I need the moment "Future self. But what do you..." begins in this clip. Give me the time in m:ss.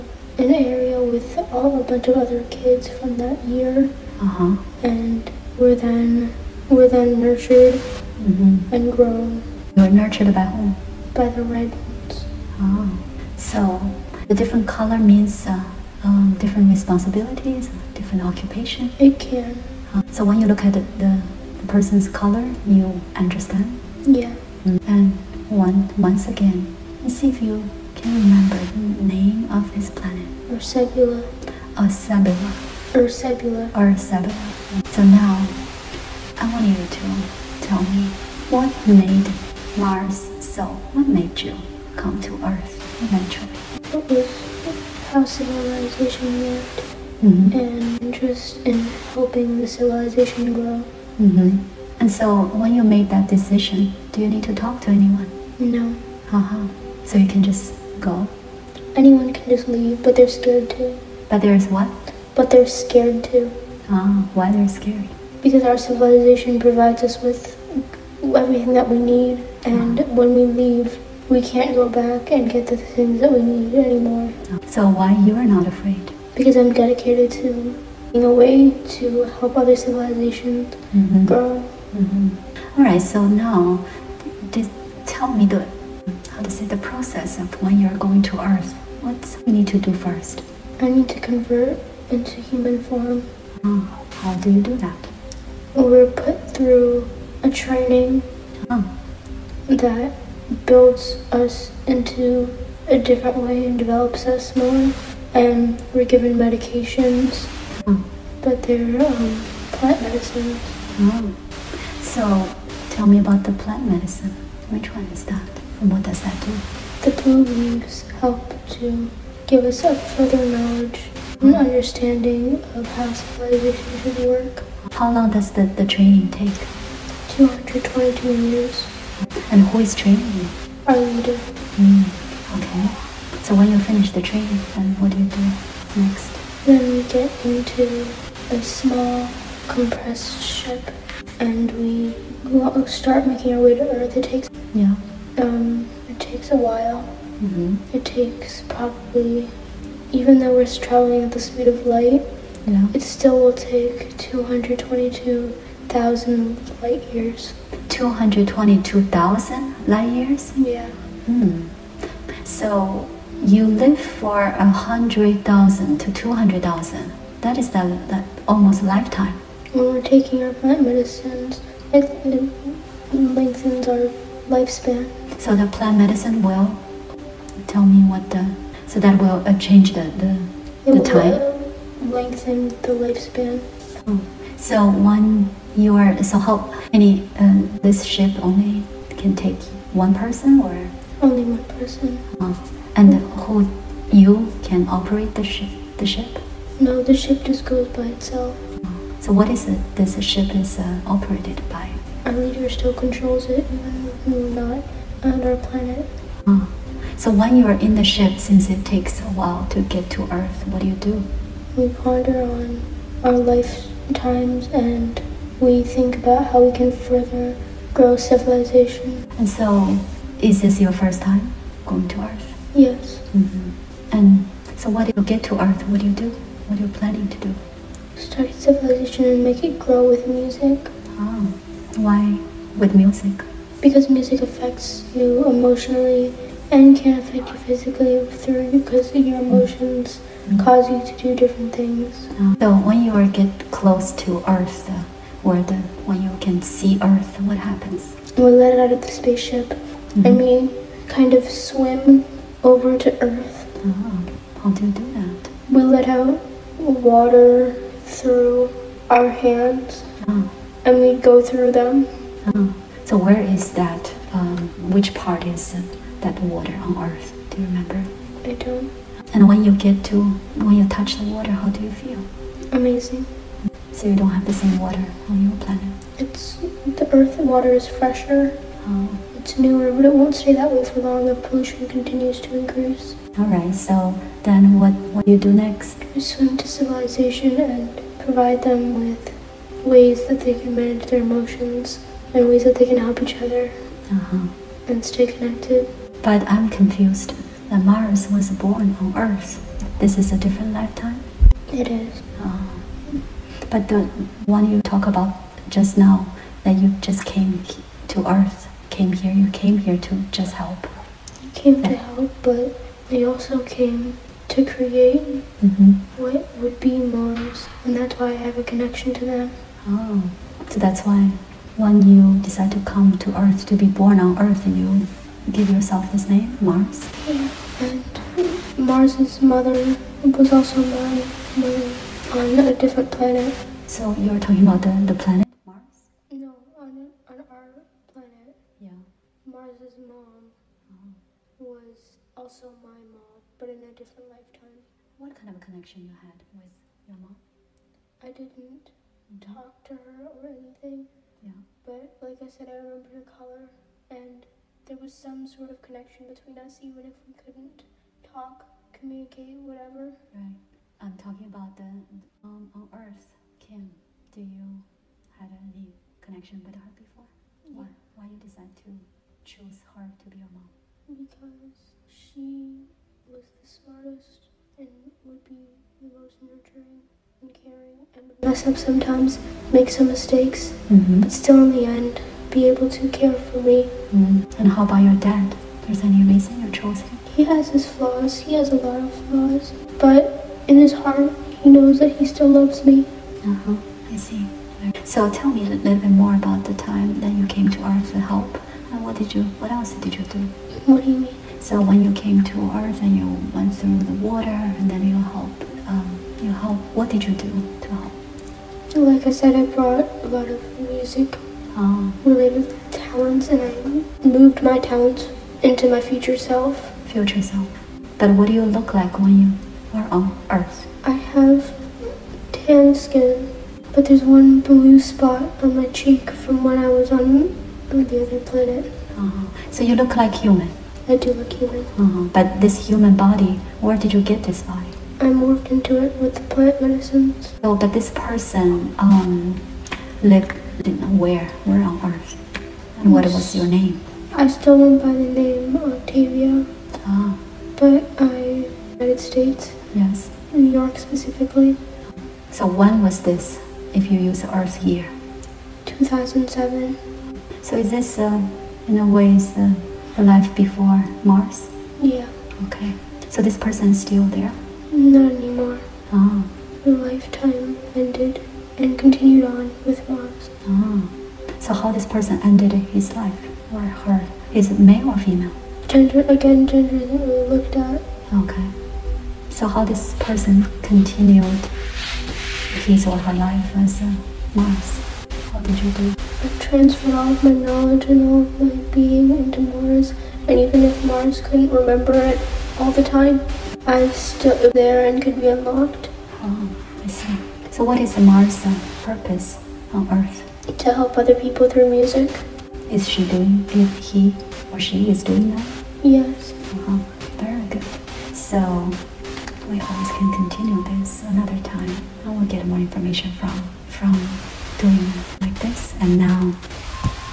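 6:57.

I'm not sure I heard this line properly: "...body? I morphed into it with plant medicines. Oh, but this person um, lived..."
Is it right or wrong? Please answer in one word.
right.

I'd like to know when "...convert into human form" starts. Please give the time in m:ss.
1:31.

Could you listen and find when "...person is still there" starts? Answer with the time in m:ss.
7:43.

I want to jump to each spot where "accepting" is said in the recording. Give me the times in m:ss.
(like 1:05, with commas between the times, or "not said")
not said.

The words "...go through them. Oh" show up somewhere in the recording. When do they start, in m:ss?
4:21.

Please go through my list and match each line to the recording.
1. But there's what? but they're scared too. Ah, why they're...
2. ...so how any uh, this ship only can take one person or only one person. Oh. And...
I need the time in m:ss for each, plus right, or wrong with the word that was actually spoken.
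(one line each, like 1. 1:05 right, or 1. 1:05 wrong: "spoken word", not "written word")
1. 1:01 right
2. 3:06 right.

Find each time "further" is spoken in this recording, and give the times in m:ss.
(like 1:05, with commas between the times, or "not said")
1:59, 3:36.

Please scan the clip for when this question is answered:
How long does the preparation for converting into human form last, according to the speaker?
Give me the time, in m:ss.
2:07.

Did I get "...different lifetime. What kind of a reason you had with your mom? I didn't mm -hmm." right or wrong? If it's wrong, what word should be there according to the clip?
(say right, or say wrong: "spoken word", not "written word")
wrong: "connection", not "reason".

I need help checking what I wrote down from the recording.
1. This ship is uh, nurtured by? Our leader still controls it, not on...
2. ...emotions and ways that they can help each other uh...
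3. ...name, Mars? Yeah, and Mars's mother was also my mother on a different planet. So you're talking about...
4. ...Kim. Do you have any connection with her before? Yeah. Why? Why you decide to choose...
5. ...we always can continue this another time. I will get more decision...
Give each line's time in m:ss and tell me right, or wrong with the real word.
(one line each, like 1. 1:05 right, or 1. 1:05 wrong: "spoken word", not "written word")
1. 3:19 wrong: "operated", not "nurtured"
2. 4:51 right
3. 5:26 right
4. 6:03 right
5. 8:29 wrong: "information", not "decision".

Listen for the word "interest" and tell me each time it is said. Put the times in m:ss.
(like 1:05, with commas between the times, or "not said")
0:48.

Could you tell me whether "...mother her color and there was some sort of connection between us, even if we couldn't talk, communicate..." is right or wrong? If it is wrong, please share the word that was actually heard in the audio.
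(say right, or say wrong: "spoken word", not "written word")
wrong: "remember", not "mother".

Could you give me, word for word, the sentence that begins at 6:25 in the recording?
There's any reason you chose him?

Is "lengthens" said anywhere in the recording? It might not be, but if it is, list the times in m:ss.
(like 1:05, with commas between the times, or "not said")
2:53, 3:02.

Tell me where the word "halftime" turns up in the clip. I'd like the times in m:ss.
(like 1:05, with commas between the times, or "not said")
not said.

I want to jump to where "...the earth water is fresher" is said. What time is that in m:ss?
4:36.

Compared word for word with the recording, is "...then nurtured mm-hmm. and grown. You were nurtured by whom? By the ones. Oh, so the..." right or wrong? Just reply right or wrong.
right.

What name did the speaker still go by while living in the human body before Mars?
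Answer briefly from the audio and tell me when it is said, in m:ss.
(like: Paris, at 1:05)
Octavia, at 7:25.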